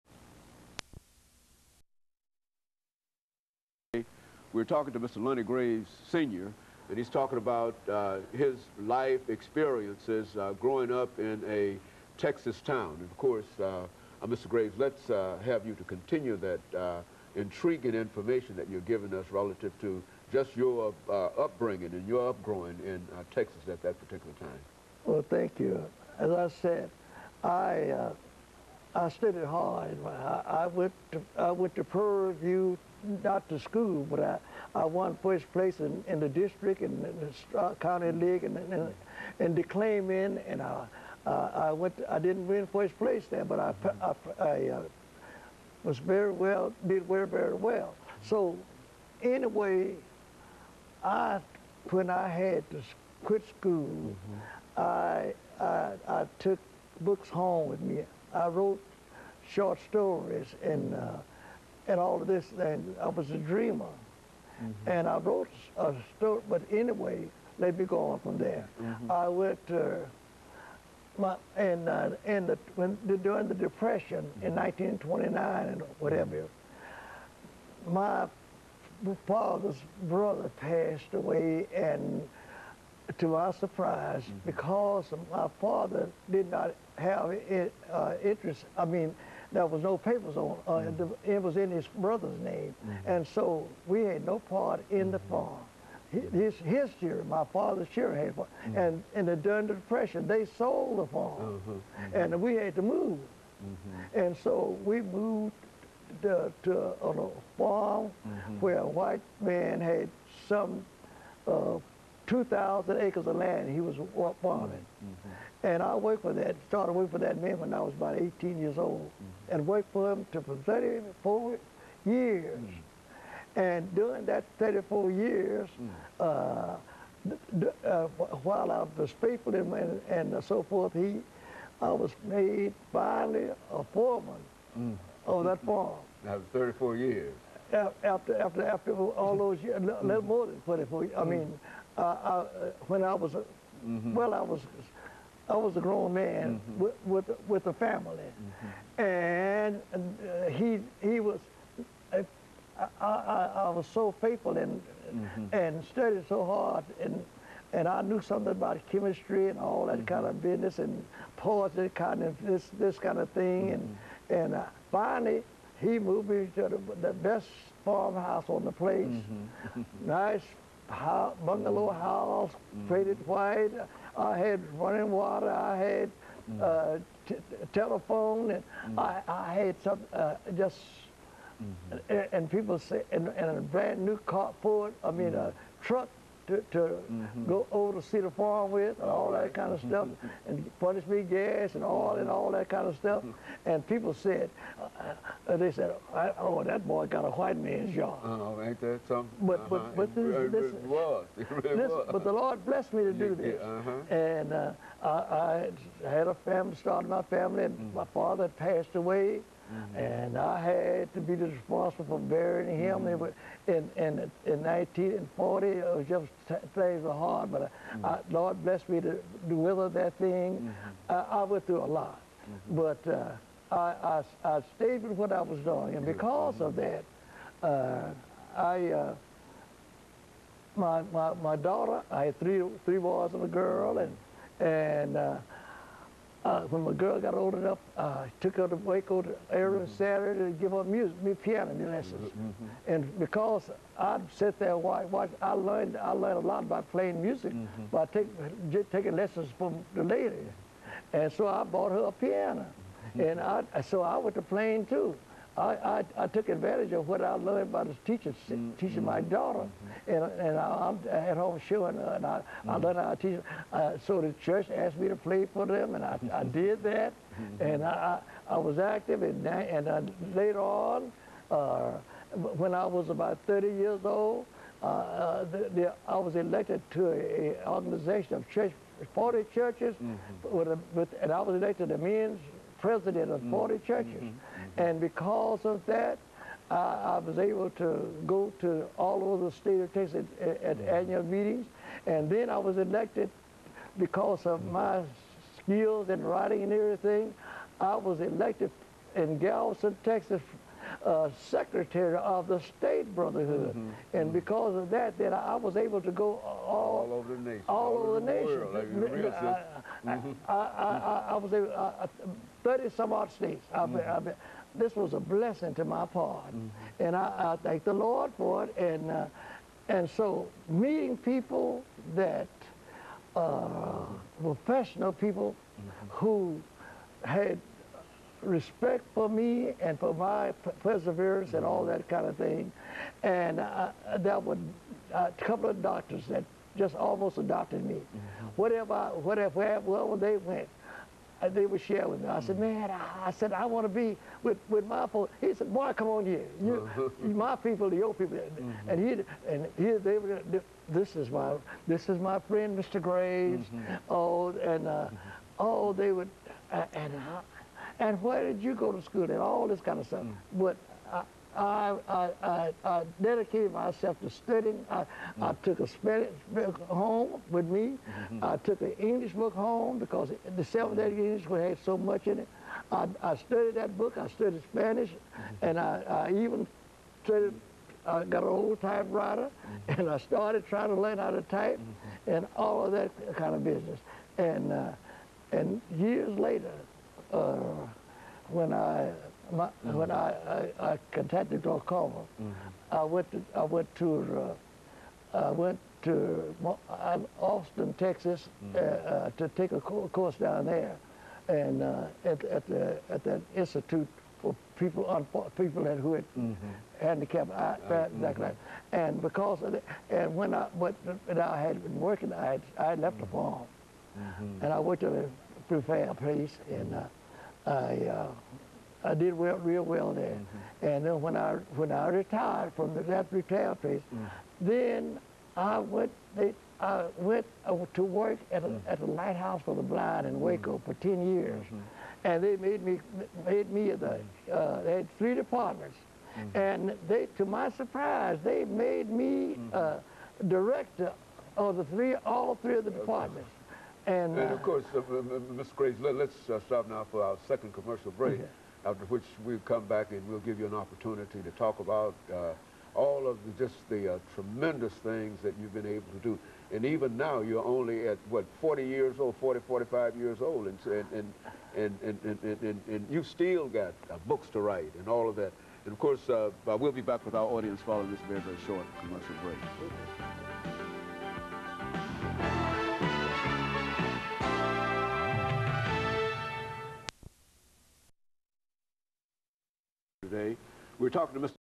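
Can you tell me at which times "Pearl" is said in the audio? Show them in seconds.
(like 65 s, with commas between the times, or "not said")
31 s.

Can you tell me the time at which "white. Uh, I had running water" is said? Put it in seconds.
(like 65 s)
173 s.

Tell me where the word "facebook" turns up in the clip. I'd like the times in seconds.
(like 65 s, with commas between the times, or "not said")
not said.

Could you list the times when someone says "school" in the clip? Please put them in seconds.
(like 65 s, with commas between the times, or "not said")
33 s, 53 s, 359 s.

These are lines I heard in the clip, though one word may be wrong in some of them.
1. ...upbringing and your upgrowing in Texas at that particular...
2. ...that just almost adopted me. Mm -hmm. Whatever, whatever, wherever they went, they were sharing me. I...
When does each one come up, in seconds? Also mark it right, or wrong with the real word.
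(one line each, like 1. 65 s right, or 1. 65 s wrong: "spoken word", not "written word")
1. 21 s right
2. 336 s right.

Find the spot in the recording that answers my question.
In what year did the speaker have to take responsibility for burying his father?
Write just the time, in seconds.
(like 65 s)
214 s.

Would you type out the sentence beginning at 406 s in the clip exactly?
handicapped eye, uh, that, mm -hmm.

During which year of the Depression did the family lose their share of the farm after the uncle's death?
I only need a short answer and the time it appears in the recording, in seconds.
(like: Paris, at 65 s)
1929, at 74 s.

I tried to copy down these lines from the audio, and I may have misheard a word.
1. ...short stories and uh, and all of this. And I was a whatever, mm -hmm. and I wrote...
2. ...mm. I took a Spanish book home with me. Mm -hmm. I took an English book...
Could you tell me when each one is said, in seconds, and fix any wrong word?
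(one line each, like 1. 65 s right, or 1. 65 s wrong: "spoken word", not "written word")
1. 59 s wrong: "dreamer", not "whatever"
2. 365 s right.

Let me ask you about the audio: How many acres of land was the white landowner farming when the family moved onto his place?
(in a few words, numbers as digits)
2,000.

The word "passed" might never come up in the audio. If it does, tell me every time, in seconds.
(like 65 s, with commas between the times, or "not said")
80 s, 208 s.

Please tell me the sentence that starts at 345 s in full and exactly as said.
He said, boy, come on here.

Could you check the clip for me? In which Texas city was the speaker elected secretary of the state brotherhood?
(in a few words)
Galveston.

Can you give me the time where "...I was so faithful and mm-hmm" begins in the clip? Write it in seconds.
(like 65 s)
153 s.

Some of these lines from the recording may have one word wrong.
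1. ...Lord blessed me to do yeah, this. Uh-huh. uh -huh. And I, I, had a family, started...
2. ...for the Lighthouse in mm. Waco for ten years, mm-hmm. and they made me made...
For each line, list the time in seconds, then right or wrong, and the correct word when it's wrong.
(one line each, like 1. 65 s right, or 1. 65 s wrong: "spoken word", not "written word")
1. 202 s right
2. 429 s wrong: "Blind", not "Lighthouse".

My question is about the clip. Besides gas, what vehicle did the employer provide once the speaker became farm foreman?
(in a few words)
A truck.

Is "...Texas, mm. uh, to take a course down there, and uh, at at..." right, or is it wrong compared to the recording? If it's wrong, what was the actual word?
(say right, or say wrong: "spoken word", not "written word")
right.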